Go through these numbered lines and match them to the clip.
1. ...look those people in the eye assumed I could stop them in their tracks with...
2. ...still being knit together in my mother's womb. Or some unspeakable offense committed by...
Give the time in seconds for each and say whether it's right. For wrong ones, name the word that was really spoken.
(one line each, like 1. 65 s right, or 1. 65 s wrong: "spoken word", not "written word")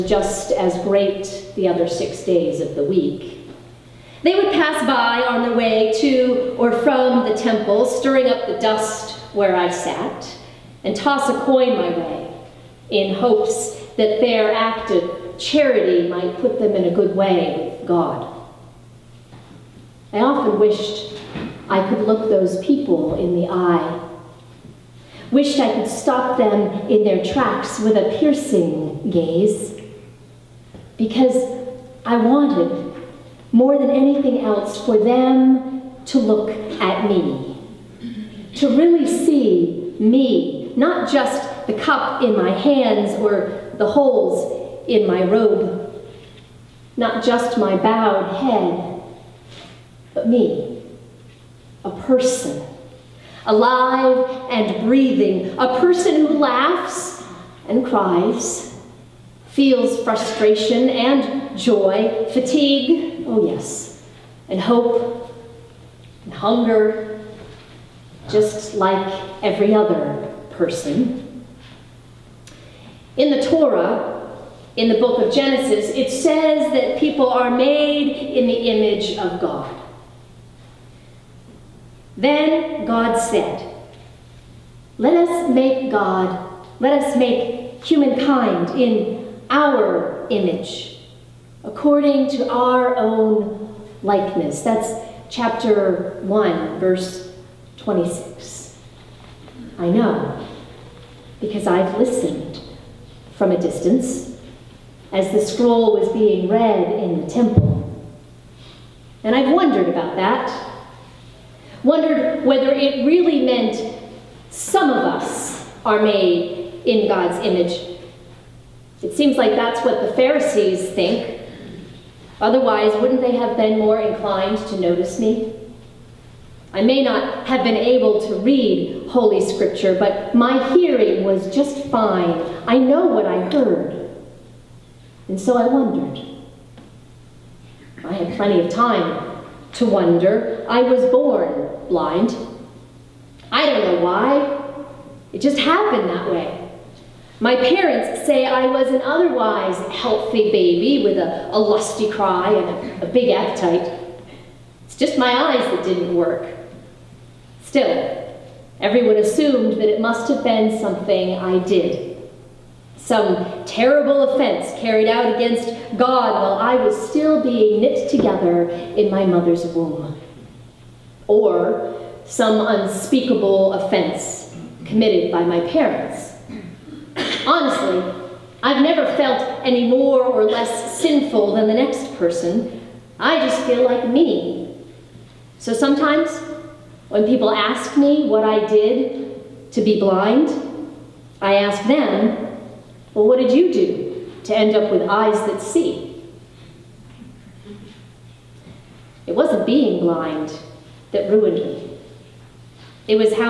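1. 21 s wrong: "wished", not "assumed"
2. 167 s right.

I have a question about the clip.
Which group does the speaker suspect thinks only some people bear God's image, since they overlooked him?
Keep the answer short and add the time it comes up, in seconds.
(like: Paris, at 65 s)
The Pharisees, at 120 s.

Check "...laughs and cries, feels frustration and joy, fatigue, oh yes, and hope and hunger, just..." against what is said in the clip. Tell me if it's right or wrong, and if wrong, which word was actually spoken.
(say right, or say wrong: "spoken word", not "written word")
right.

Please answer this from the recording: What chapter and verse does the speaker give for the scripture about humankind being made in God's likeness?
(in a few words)
Chapter 1, verse 26.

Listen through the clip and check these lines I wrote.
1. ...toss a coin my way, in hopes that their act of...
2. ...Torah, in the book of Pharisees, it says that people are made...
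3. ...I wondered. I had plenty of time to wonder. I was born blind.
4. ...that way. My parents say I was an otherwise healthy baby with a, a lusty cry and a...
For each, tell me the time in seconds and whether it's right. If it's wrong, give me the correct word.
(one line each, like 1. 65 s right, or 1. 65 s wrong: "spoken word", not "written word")
1. 10 s right
2. 73 s wrong: "Genesis", not "Pharisees"
3. 135 s right
4. 146 s right.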